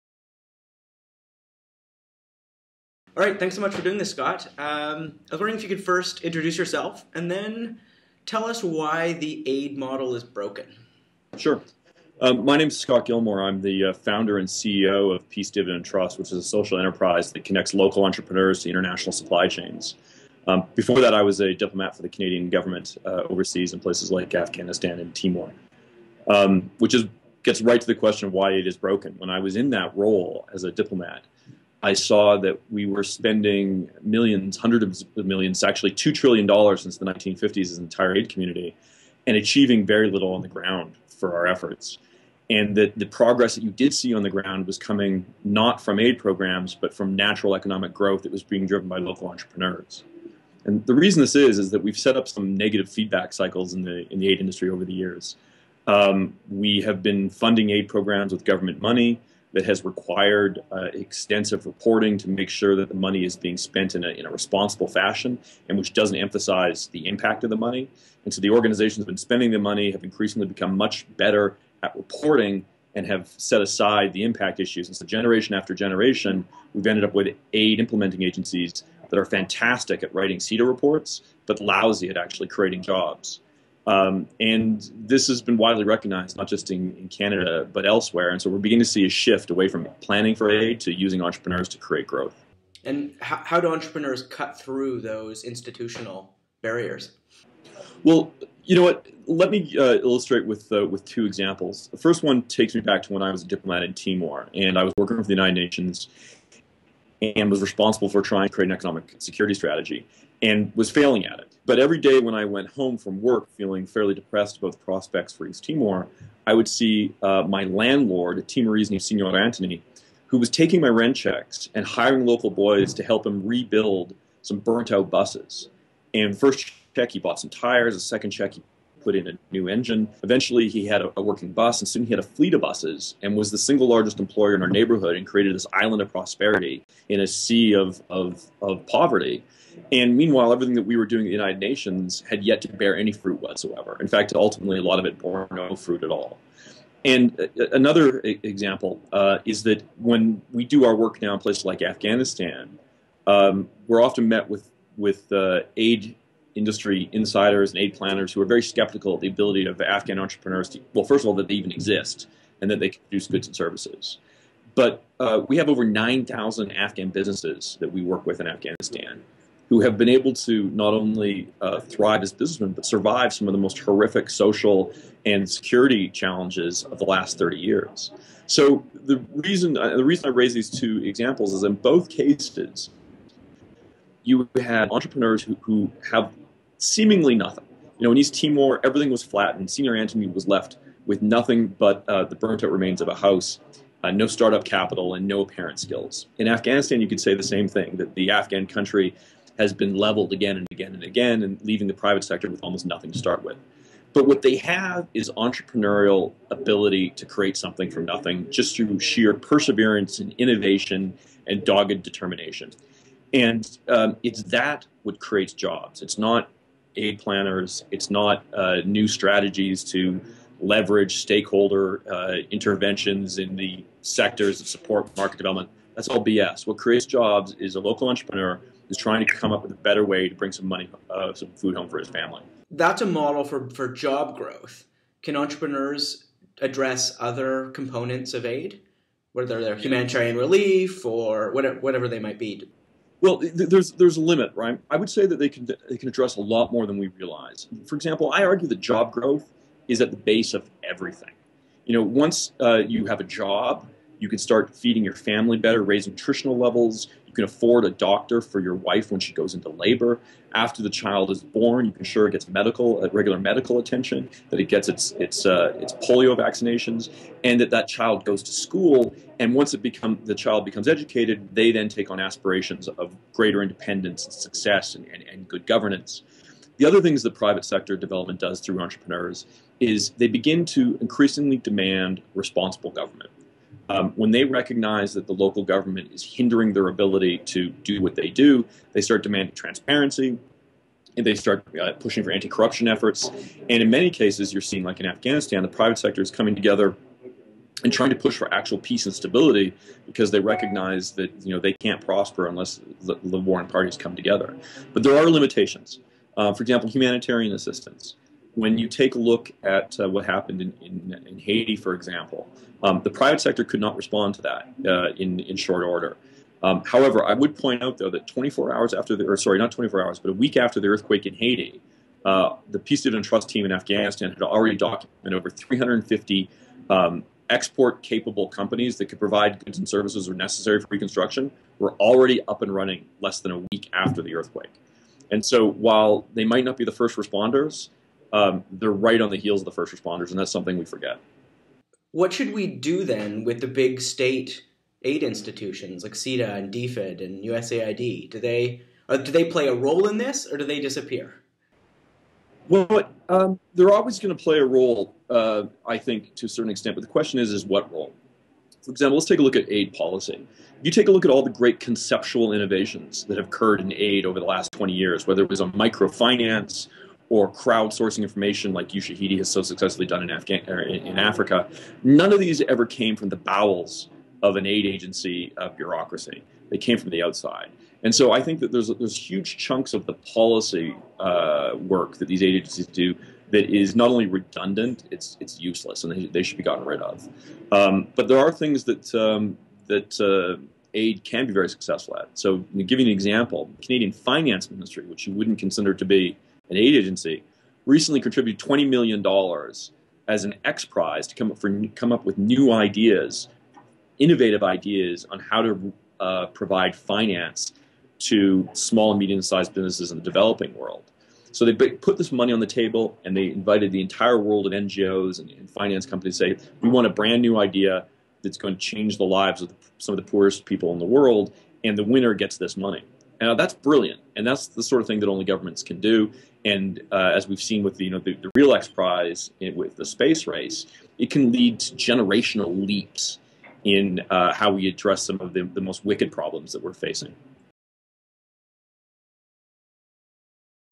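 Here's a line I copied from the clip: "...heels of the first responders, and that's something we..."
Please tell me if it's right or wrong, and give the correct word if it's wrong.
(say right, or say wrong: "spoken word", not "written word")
right.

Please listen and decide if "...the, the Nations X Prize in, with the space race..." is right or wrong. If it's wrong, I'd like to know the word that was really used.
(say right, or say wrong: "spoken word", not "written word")
wrong: "Real", not "Nations".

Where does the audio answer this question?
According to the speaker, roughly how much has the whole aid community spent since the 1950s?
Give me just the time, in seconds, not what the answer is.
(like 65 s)
35 s.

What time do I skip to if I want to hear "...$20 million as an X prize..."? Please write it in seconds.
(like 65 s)
398 s.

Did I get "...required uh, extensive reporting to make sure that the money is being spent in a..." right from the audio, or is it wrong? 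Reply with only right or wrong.
right.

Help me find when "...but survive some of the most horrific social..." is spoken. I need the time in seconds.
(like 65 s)
172 s.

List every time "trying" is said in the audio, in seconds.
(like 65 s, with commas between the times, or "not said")
108 s, 228 s, 297 s.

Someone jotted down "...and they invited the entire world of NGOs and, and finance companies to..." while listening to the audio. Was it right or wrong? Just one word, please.
right.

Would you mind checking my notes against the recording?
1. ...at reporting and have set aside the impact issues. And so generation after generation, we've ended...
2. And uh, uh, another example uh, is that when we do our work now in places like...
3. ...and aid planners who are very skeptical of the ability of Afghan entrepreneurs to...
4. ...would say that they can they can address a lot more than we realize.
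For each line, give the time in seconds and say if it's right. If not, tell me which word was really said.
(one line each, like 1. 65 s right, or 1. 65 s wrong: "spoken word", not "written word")
1. 71 s right
2. 147 s right
3. 157 s right
4. 244 s right.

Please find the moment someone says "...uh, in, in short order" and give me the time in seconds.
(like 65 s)
314 s.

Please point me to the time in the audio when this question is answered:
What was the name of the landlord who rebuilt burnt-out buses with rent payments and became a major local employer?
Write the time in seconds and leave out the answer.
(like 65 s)
119 s.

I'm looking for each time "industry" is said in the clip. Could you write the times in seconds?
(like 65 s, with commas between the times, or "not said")
54 s, 156 s.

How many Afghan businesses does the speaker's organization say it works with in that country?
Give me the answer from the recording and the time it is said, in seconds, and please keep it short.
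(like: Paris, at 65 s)
Over 9,000, at 165 s.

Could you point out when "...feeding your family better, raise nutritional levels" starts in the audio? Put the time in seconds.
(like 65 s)
254 s.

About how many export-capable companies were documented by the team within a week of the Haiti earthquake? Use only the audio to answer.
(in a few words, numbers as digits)
Over 350.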